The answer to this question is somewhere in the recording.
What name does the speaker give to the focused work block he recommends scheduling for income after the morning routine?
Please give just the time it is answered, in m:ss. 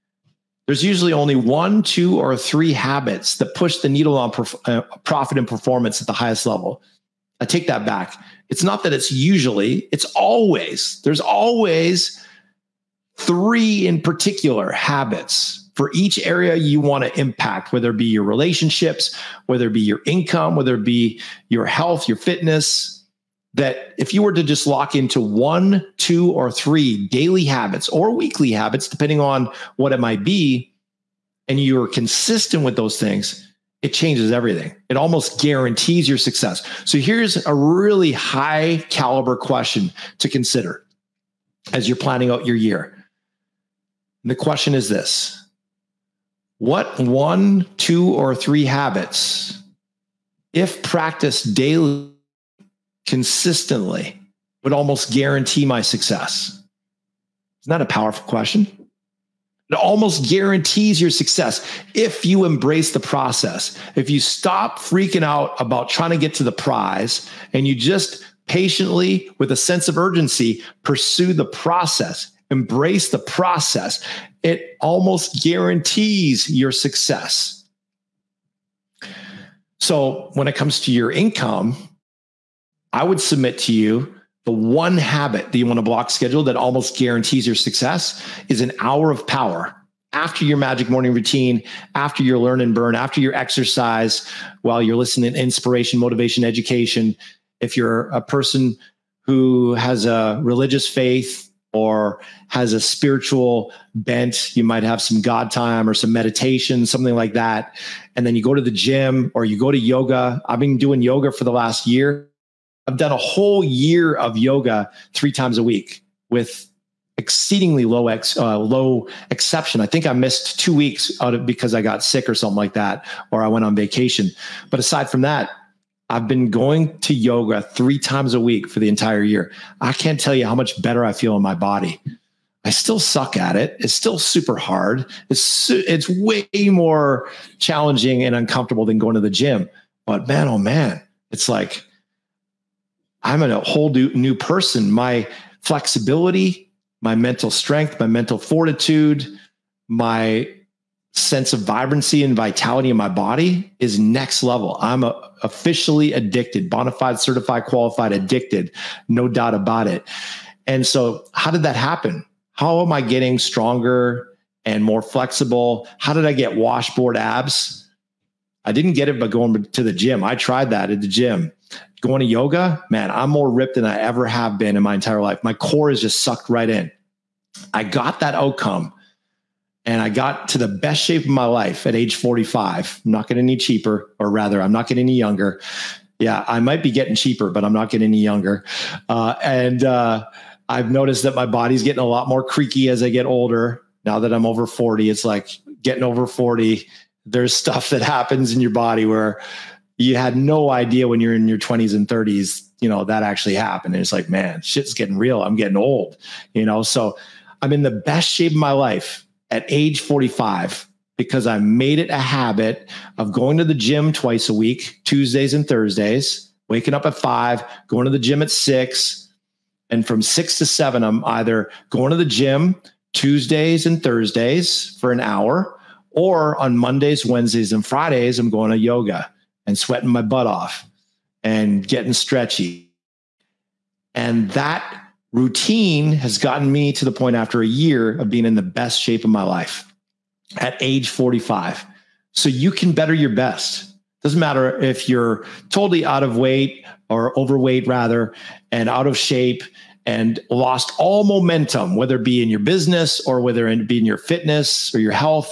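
1:28.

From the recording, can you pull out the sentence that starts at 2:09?
I can't tell you how much better I feel in my body.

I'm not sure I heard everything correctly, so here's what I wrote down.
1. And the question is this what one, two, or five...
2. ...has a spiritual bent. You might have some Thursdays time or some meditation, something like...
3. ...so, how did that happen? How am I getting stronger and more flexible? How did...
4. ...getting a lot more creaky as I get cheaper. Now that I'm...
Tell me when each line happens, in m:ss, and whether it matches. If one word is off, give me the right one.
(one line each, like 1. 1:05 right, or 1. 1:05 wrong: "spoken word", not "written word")
1. 0:44 wrong: "three", not "five"
2. 1:42 wrong: "God", not "Thursdays"
3. 2:40 right
4. 3:11 wrong: "older", not "cheaper".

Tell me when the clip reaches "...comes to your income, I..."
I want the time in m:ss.
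1:20.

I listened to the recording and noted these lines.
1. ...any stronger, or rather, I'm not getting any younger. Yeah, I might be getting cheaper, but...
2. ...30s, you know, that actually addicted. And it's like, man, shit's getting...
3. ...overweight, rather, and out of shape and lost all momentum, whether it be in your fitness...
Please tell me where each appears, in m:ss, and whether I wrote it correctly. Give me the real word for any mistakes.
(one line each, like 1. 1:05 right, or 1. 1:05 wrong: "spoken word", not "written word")
1. 3:03 wrong: "cheaper", not "stronger"
2. 3:22 wrong: "happened", not "addicted"
3. 4:07 wrong: "business", not "fitness".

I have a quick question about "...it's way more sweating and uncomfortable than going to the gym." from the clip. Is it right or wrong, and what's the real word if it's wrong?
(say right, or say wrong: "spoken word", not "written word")
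wrong: "challenging", not "sweating".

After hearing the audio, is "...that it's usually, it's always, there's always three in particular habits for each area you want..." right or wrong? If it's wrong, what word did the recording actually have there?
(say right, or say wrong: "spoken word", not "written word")
right.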